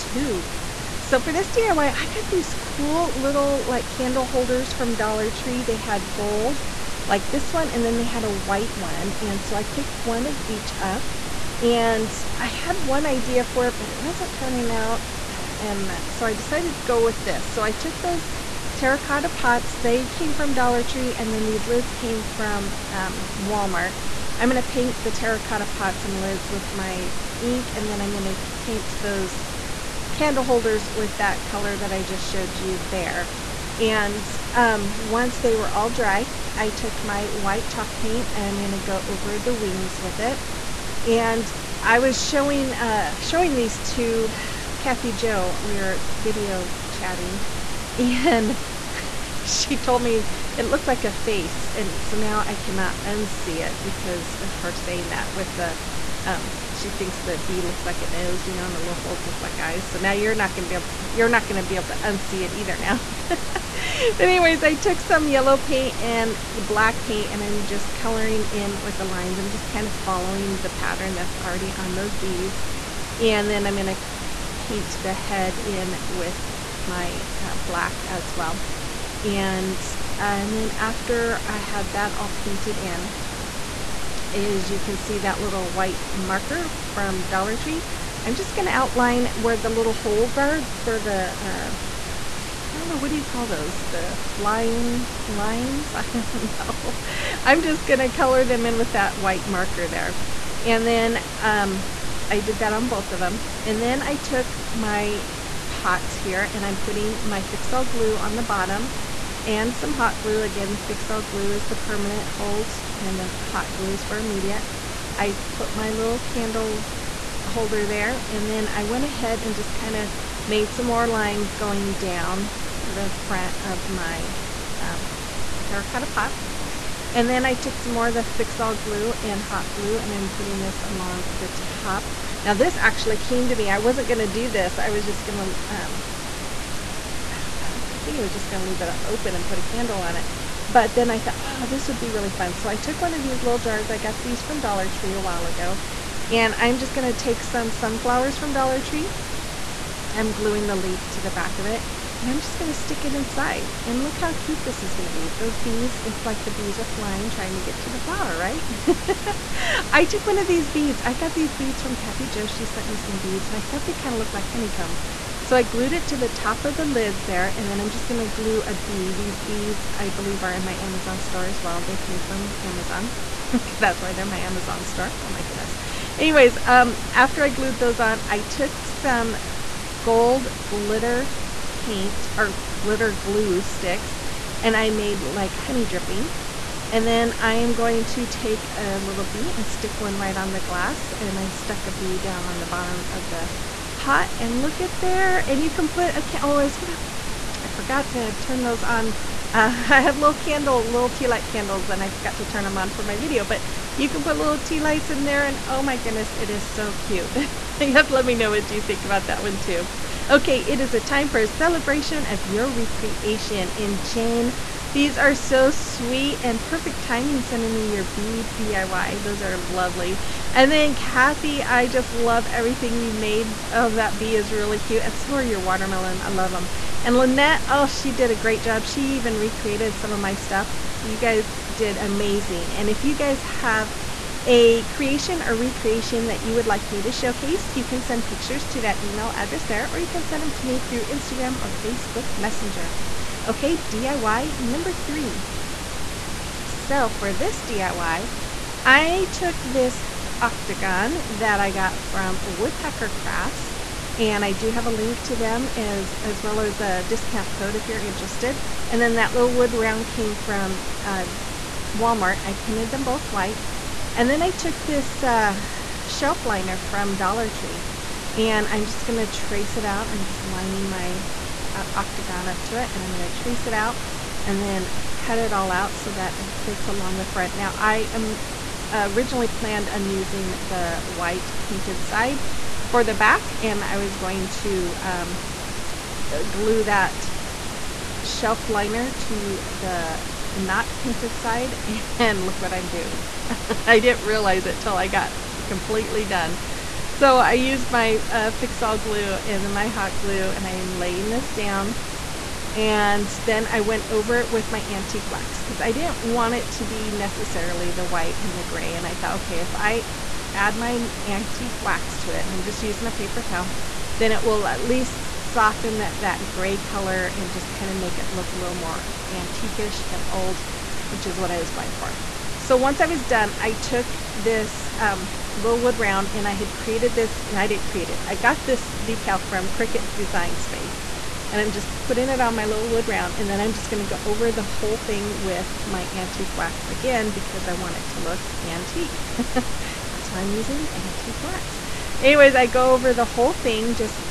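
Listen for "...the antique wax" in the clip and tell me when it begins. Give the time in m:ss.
5:40.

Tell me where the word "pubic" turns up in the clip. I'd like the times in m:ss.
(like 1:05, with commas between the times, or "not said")
not said.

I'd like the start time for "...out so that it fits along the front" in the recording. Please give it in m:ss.
4:35.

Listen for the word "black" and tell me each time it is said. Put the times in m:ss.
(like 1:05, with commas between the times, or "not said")
1:06, 1:17.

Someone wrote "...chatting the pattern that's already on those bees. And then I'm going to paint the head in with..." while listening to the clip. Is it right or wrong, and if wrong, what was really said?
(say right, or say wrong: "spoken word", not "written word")
wrong: "following", not "chatting".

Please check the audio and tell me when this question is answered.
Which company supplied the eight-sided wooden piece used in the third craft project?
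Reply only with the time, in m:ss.
4:12.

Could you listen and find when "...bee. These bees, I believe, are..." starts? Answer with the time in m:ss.
2:48.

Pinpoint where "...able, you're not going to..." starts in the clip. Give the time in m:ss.
1:00.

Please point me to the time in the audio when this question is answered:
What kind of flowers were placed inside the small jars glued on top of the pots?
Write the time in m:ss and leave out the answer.
2:27.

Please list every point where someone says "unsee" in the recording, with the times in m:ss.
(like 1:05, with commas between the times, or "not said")
0:53, 1:02.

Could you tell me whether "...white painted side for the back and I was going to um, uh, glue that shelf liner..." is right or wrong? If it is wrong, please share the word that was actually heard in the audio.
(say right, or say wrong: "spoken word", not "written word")
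right.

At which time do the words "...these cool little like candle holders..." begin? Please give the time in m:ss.
0:02.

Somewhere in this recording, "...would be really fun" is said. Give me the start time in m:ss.
2:21.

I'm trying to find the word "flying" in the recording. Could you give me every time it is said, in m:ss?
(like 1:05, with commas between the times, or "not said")
1:34, 2:36.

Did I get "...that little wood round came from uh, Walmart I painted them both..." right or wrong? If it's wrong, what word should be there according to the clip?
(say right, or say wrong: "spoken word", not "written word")
right.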